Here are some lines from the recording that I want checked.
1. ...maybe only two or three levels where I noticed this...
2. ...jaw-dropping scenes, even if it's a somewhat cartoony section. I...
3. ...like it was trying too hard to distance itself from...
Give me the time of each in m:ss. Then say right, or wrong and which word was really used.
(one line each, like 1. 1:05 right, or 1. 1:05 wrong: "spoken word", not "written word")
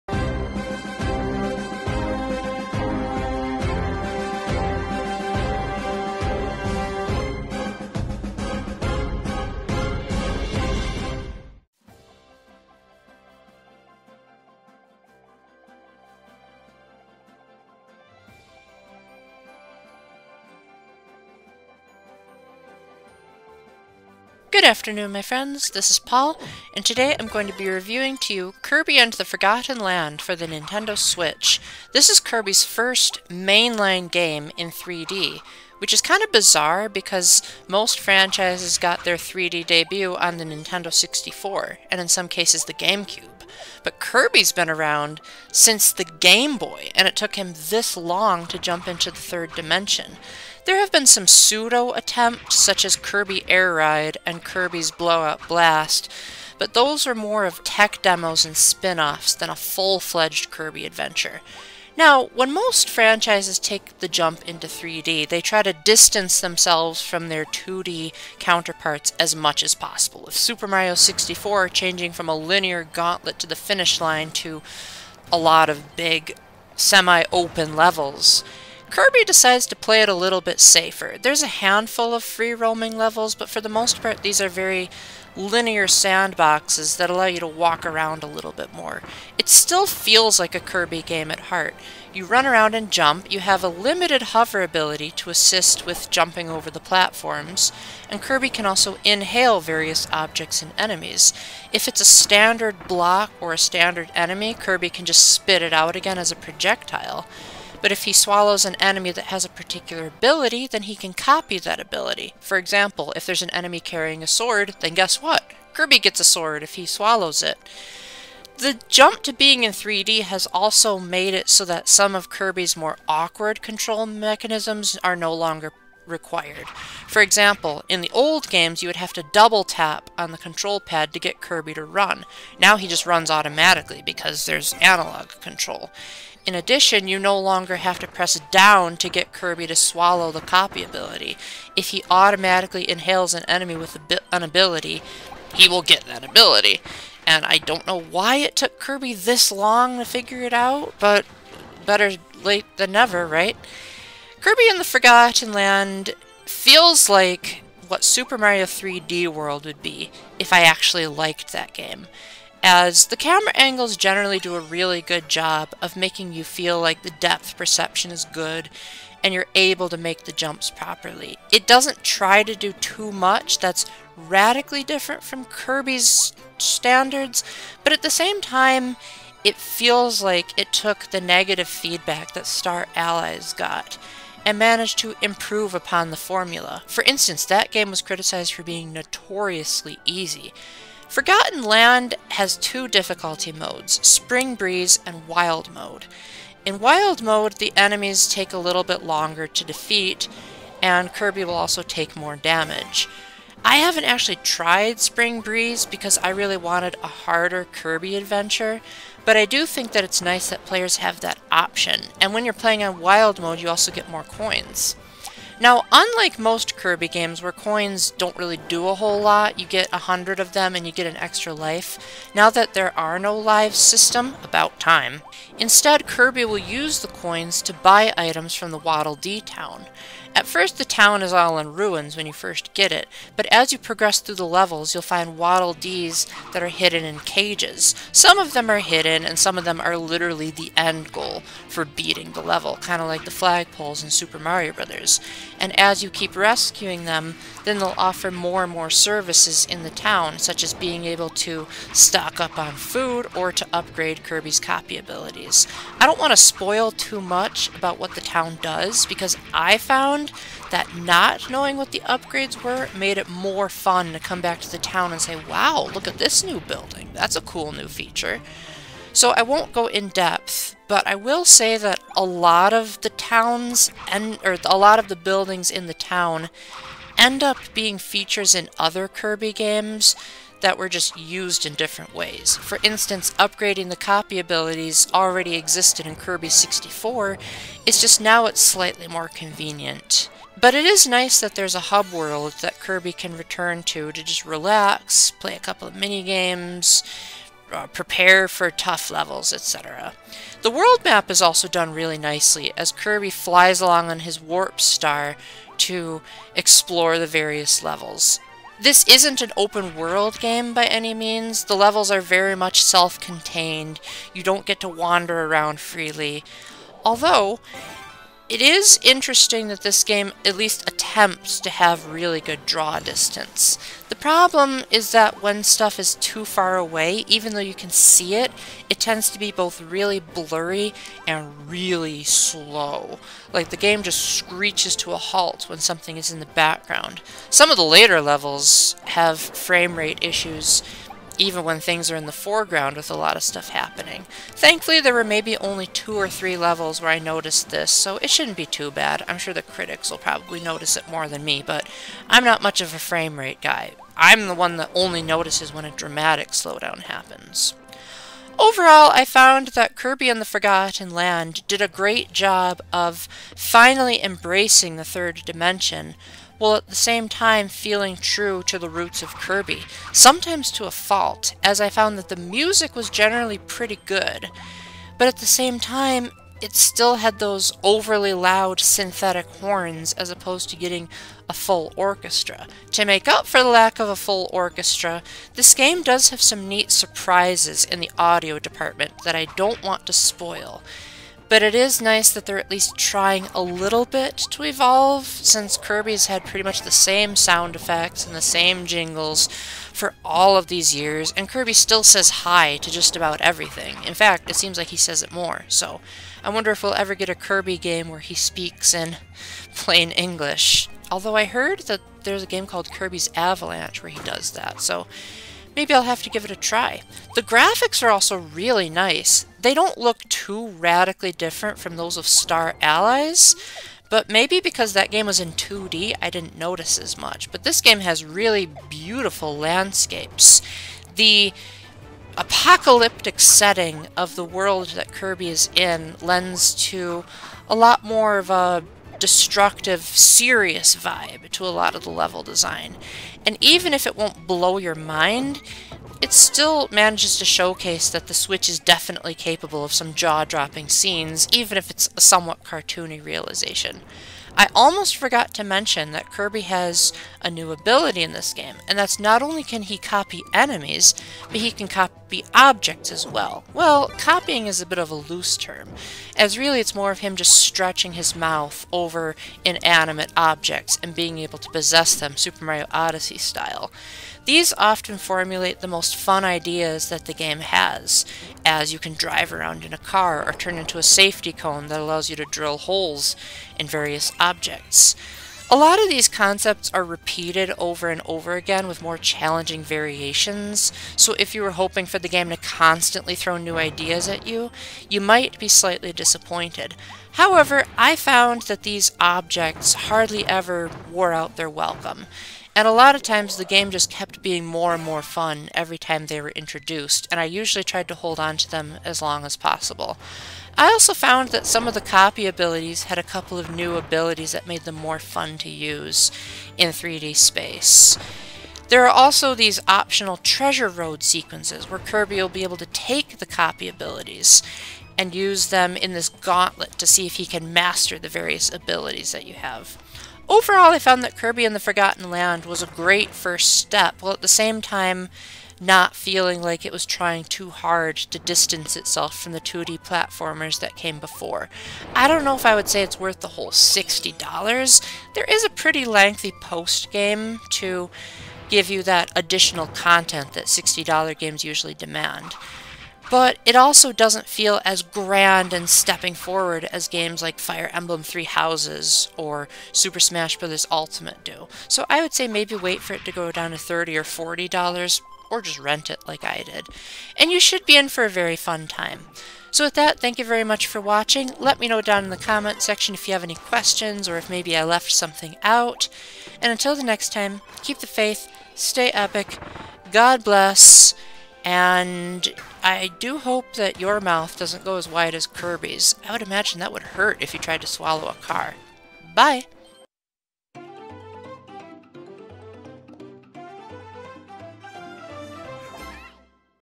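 1. 5:45 right
2. 7:30 wrong: "realization", not "section"
3. 8:56 right.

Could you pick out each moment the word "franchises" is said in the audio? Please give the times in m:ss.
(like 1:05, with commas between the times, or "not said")
0:37, 1:02.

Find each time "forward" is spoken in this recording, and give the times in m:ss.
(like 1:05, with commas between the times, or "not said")
9:16.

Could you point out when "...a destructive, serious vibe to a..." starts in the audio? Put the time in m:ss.
7:18.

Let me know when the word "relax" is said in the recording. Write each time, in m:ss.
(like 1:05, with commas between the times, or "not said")
4:54.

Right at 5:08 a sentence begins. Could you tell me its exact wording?
This isn't an open world game by any means.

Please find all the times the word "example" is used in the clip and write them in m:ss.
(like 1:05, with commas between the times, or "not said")
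1:52, 2:07.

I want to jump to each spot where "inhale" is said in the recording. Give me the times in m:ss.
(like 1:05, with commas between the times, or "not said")
1:39, 2:22.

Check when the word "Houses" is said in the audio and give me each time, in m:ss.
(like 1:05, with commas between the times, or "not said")
9:18.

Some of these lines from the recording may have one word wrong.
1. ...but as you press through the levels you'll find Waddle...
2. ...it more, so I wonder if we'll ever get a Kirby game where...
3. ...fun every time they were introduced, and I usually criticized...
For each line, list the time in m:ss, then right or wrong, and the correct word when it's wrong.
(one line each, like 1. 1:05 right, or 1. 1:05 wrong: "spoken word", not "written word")
1. 3:53 wrong: "progress", not "press"
2. 6:45 right
3. 8:25 wrong: "tried", not "criticized".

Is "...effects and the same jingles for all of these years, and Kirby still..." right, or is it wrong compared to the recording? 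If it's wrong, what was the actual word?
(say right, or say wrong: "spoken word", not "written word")
right.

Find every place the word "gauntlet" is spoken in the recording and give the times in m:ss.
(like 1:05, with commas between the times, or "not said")
1:12, 8:46.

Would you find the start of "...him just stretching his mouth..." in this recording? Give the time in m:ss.
7:47.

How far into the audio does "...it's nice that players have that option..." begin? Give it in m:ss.
3:30.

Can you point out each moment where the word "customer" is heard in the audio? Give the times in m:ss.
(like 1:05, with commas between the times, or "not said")
not said.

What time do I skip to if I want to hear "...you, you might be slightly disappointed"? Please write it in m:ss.
8:14.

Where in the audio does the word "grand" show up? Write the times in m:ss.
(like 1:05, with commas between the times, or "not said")
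9:15.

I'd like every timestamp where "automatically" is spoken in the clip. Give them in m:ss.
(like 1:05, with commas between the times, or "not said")
2:13, 2:22.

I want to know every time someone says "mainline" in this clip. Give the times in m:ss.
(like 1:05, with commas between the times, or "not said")
0:33.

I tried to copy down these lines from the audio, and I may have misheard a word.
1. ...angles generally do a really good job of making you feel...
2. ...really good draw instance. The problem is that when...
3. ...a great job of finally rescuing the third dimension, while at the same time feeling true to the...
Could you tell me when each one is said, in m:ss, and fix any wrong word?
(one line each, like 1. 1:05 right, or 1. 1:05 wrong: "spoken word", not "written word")
1. 2:43 right
2. 5:22 wrong: "distance", not "instance"
3. 6:01 wrong: "embracing", not "rescuing".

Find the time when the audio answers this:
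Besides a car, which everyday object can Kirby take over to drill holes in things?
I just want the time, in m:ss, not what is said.
8:01.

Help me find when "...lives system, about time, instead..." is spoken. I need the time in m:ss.
3:43.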